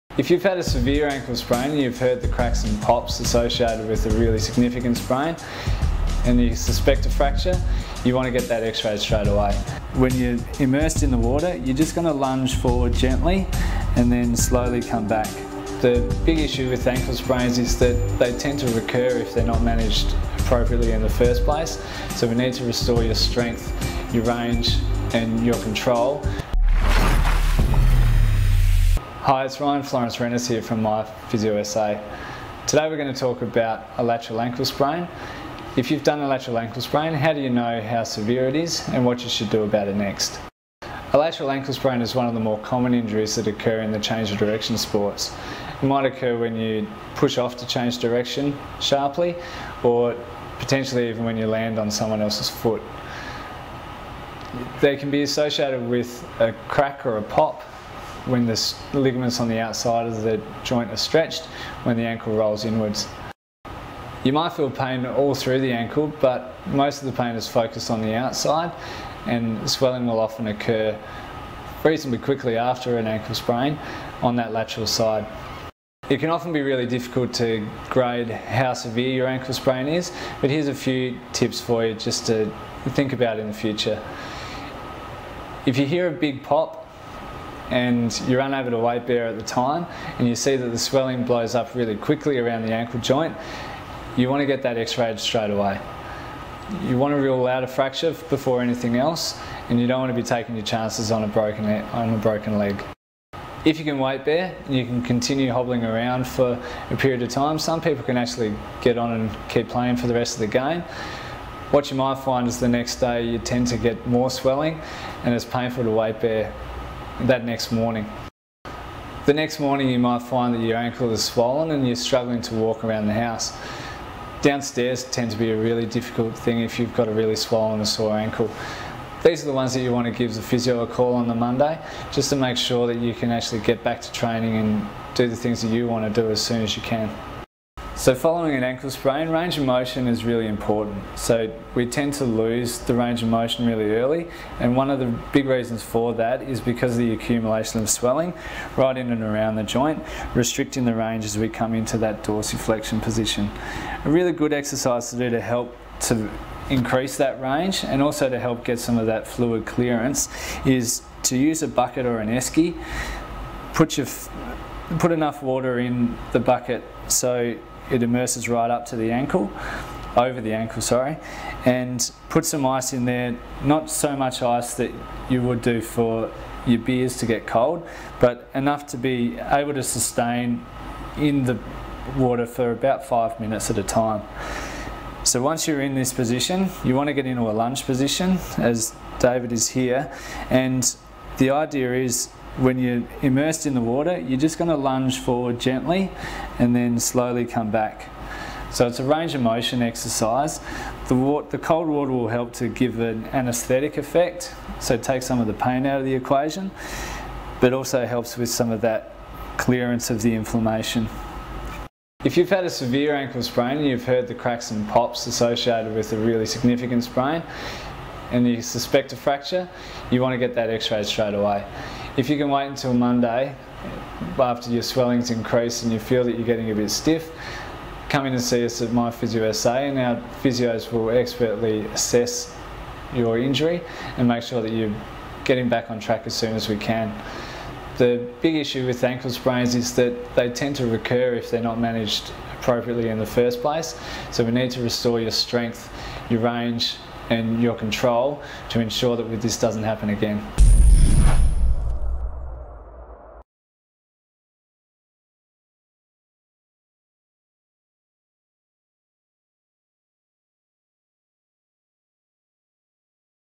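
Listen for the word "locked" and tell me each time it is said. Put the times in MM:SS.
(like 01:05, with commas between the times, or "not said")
not said.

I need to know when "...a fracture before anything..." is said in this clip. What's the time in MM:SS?
01:37.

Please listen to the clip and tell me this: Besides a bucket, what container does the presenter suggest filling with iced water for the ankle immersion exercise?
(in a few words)
Esky.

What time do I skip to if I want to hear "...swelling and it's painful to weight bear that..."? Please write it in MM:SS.
01:54.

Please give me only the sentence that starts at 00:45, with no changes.
It might occur when you push off to change direction sharply or potentially even when you land on someone else's foot.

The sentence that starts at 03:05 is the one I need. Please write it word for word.
So once you're in this position, you want to get into a lunge position as David is here.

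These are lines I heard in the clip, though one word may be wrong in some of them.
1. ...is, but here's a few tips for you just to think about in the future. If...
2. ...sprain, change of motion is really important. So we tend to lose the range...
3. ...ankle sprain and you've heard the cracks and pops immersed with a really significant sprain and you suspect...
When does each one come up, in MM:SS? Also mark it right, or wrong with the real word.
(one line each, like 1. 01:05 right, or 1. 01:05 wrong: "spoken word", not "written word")
1. 01:19 right
2. 02:18 wrong: "range", not "change"
3. 03:33 wrong: "associated", not "immersed".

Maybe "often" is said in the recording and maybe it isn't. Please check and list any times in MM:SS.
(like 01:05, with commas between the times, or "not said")
01:10, 01:16.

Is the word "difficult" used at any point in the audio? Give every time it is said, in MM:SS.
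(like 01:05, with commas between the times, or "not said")
01:16, 02:05.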